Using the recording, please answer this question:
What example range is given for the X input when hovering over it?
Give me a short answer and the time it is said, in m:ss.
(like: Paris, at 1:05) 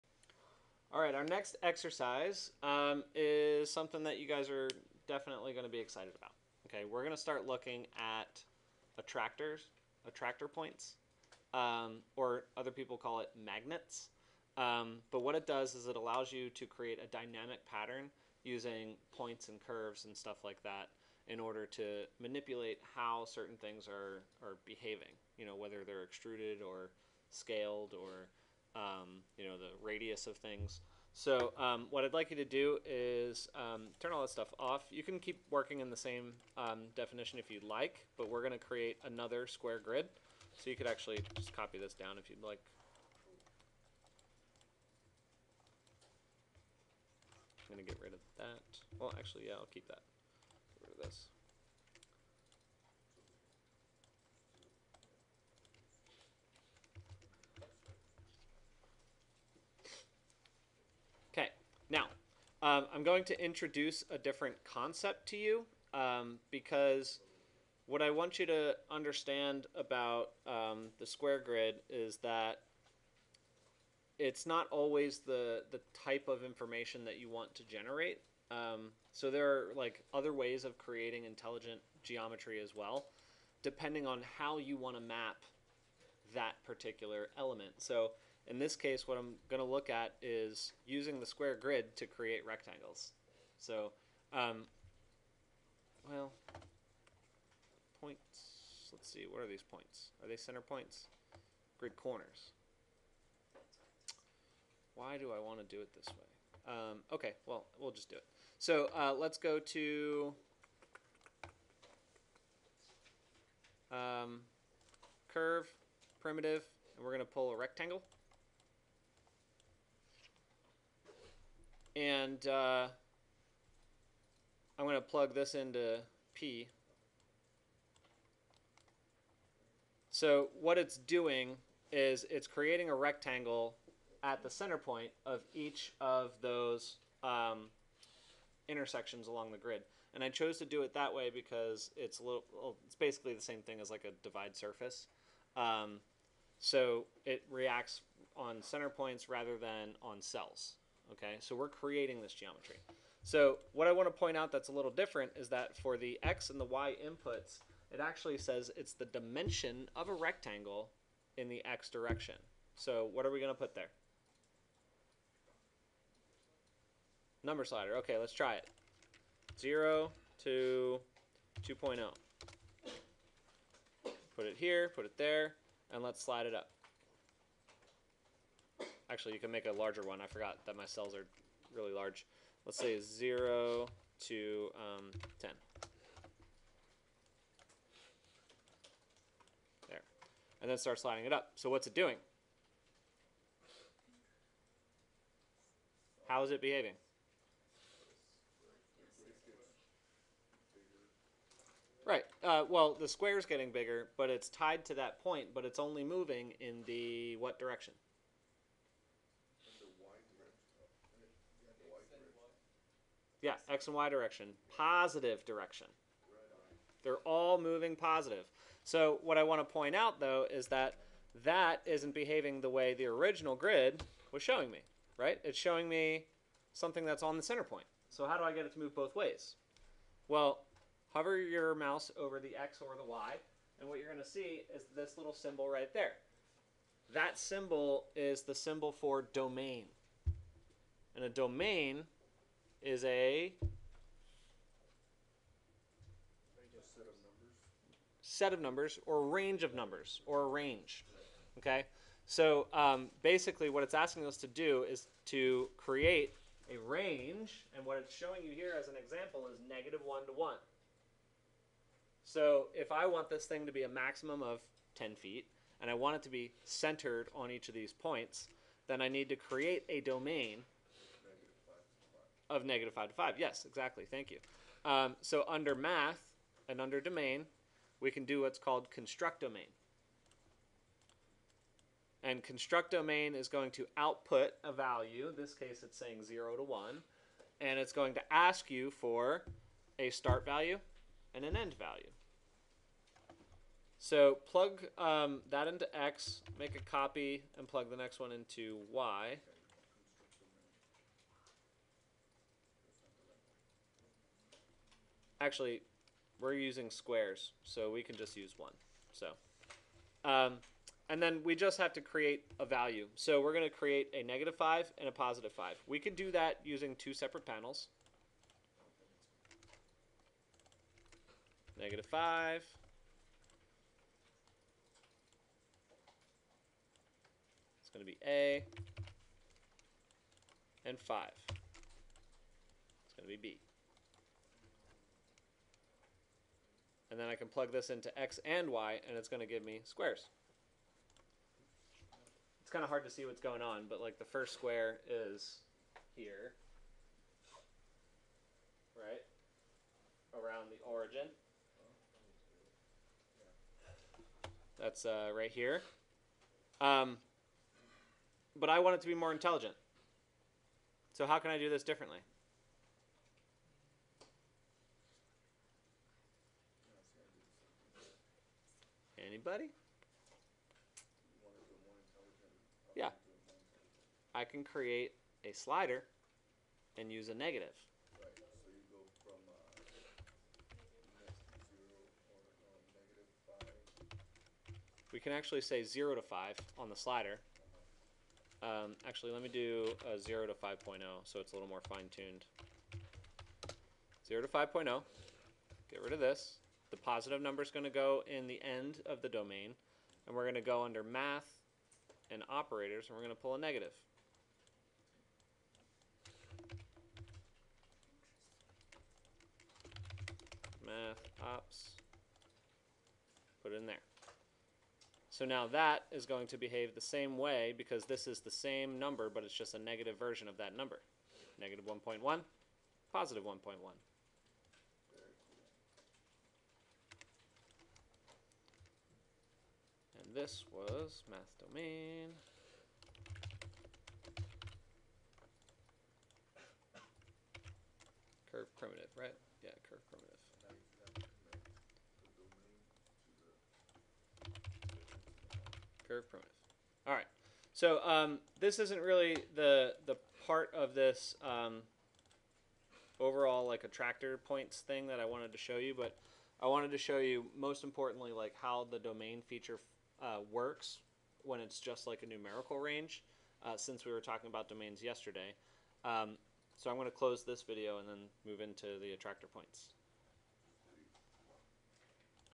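-1 to 1, at 4:19.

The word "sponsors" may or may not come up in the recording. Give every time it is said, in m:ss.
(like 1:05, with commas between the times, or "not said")
not said.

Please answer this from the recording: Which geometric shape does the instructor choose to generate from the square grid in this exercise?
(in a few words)
Rectangles.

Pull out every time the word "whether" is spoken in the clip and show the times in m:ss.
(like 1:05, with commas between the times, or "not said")
0:25.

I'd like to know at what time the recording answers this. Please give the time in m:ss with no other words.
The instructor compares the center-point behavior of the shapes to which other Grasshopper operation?
2:24.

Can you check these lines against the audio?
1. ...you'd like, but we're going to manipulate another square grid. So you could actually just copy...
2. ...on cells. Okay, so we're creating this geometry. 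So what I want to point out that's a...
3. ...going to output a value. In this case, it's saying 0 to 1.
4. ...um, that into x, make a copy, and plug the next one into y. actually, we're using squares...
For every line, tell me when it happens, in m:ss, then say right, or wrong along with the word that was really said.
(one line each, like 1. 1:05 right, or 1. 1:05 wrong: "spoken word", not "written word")
1. 0:37 wrong: "create", not "manipulate"
2. 2:30 right
3. 4:43 right
4. 4:54 right.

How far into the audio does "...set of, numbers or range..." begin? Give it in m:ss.
4:08.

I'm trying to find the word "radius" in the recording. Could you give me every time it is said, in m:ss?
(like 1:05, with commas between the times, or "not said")
0:29.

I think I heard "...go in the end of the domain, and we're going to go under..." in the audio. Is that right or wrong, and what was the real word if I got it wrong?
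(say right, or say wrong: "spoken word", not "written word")
right.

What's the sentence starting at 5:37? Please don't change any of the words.
And then I can plug this into x and y, and it's going to give me squares.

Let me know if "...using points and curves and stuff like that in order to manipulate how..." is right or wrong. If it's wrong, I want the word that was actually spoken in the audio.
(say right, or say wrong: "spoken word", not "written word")
right.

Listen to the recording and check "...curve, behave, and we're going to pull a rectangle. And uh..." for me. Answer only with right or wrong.
wrong.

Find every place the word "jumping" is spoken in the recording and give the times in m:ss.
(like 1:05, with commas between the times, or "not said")
not said.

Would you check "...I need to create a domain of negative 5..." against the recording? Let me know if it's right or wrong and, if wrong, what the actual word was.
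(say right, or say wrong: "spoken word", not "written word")
right.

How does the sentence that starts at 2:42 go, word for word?
So what are we going to put there?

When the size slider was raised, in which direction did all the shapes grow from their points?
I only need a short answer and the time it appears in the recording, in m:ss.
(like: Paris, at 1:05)
Positive direction, at 3:34.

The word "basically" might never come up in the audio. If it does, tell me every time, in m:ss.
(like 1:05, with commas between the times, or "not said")
2:22, 4:13.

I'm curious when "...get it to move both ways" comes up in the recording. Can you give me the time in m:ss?
3:48.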